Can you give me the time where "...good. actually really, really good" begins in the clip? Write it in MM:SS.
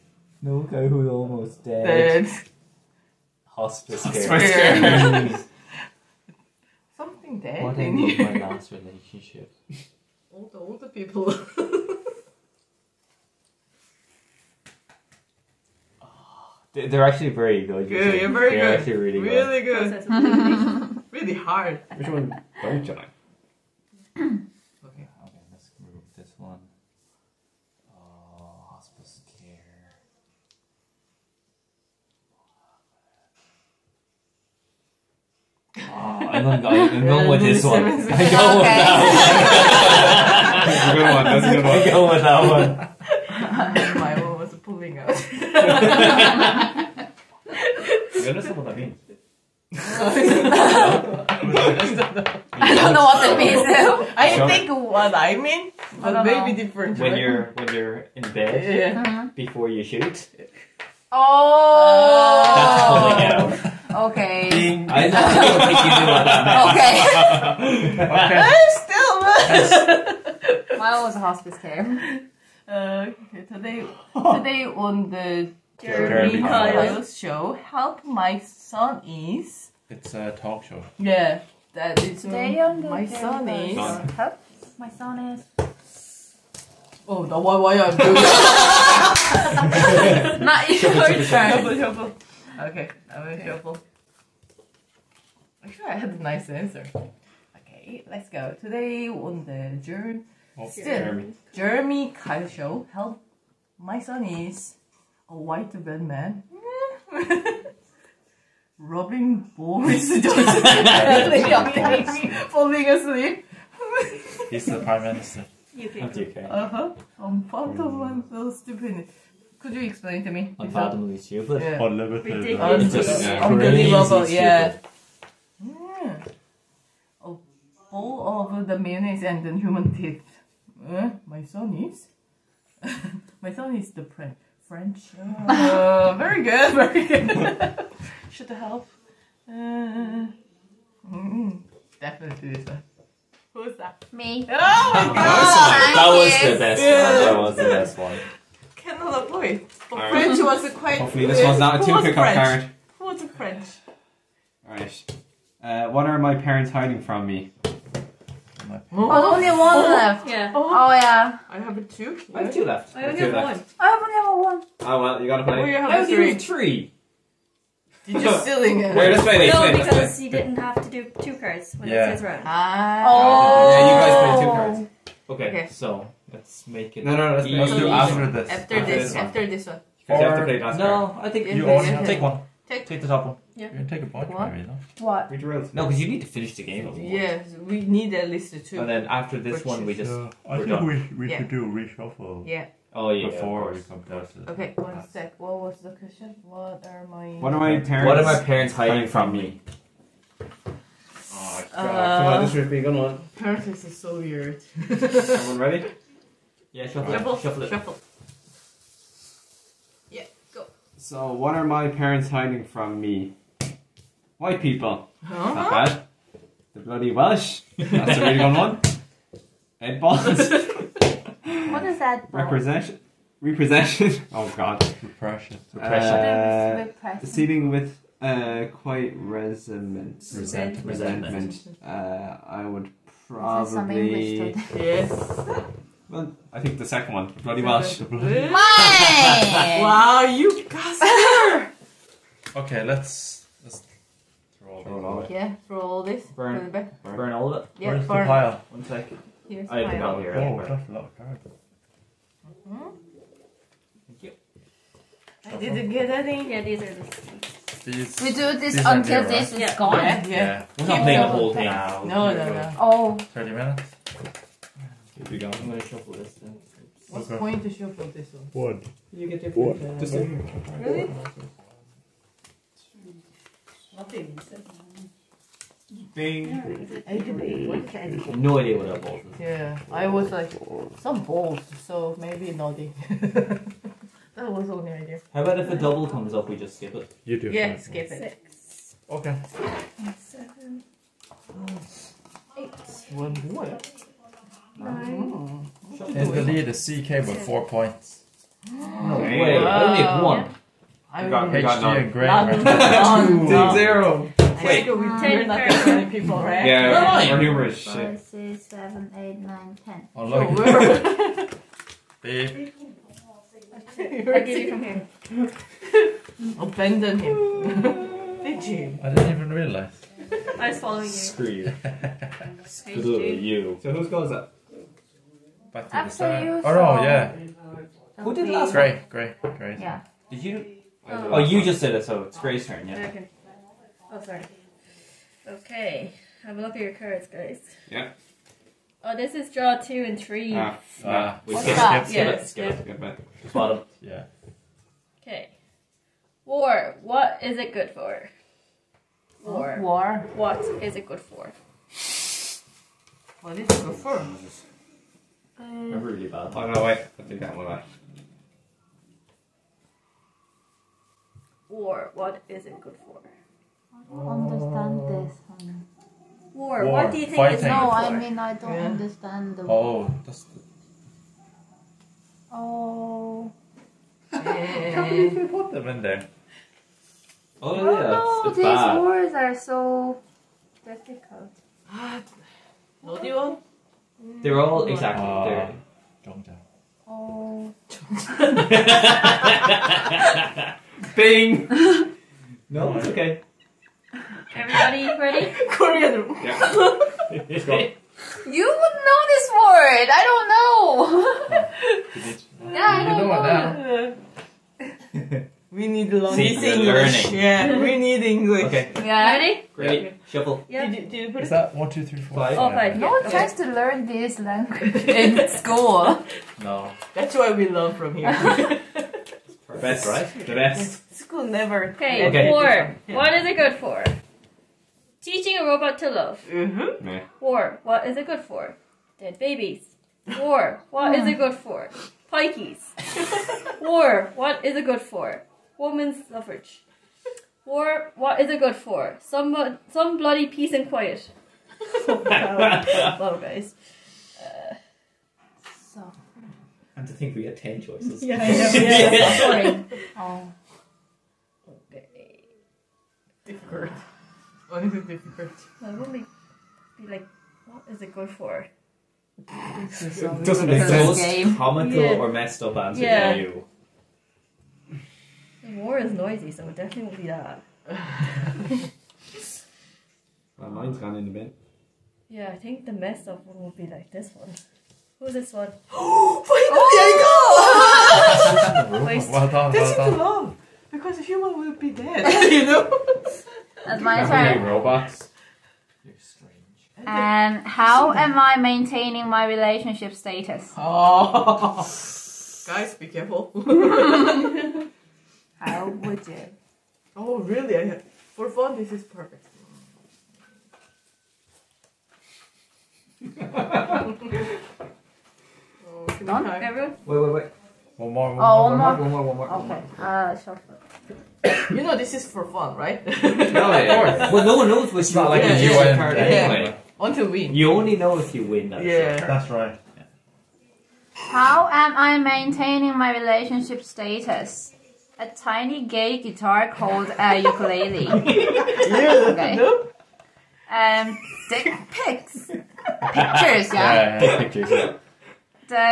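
00:18.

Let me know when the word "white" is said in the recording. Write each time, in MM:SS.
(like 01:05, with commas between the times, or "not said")
01:45, 03:34.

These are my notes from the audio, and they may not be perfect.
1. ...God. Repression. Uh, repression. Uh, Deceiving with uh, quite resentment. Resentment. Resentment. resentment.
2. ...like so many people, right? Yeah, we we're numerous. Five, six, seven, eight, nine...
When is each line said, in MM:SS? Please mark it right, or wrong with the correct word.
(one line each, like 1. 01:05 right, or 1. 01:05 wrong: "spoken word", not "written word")
1. 03:44 right
2. 05:05 right.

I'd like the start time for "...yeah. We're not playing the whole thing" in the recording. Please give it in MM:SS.
04:20.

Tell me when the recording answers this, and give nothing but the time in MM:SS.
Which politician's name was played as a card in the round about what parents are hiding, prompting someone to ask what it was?
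03:39.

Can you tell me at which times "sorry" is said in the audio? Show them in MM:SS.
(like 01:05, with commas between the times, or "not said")
05:34, 07:29.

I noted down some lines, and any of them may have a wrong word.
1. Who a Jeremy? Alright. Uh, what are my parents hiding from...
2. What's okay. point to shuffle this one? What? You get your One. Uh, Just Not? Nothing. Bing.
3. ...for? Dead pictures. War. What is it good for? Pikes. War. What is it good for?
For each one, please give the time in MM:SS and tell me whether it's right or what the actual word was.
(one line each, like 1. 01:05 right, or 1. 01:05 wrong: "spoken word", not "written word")
1. 02:32 wrong: "French", not "Jeremy"
2. 04:27 wrong: "Really", not "Not"
3. 07:08 wrong: "babies", not "pictures".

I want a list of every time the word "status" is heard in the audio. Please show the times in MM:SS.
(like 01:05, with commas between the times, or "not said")
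08:10, 08:43.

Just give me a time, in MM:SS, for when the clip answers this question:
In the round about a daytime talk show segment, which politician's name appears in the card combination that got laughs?
01:48.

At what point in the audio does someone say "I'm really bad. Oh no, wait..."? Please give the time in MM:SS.
05:55.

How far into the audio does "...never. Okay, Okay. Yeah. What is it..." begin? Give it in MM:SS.
07:01.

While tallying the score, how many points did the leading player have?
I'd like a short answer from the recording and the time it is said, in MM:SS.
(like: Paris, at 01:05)
4, at 04:57.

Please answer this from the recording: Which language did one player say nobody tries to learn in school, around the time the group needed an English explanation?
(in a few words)
Korean.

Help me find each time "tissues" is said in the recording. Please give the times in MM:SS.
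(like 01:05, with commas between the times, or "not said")
not said.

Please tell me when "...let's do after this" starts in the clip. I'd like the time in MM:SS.
02:57.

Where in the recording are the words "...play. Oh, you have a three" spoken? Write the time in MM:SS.
02:45.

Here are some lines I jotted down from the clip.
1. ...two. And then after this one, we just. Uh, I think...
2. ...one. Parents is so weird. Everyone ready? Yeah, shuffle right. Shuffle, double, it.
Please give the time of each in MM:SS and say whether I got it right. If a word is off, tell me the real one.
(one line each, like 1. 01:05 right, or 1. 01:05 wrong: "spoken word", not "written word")
1. 03:08 right
2. 03:22 wrong: "shuffle", not "double".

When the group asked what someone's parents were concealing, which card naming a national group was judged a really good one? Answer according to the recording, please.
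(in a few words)
The bloody Welsh.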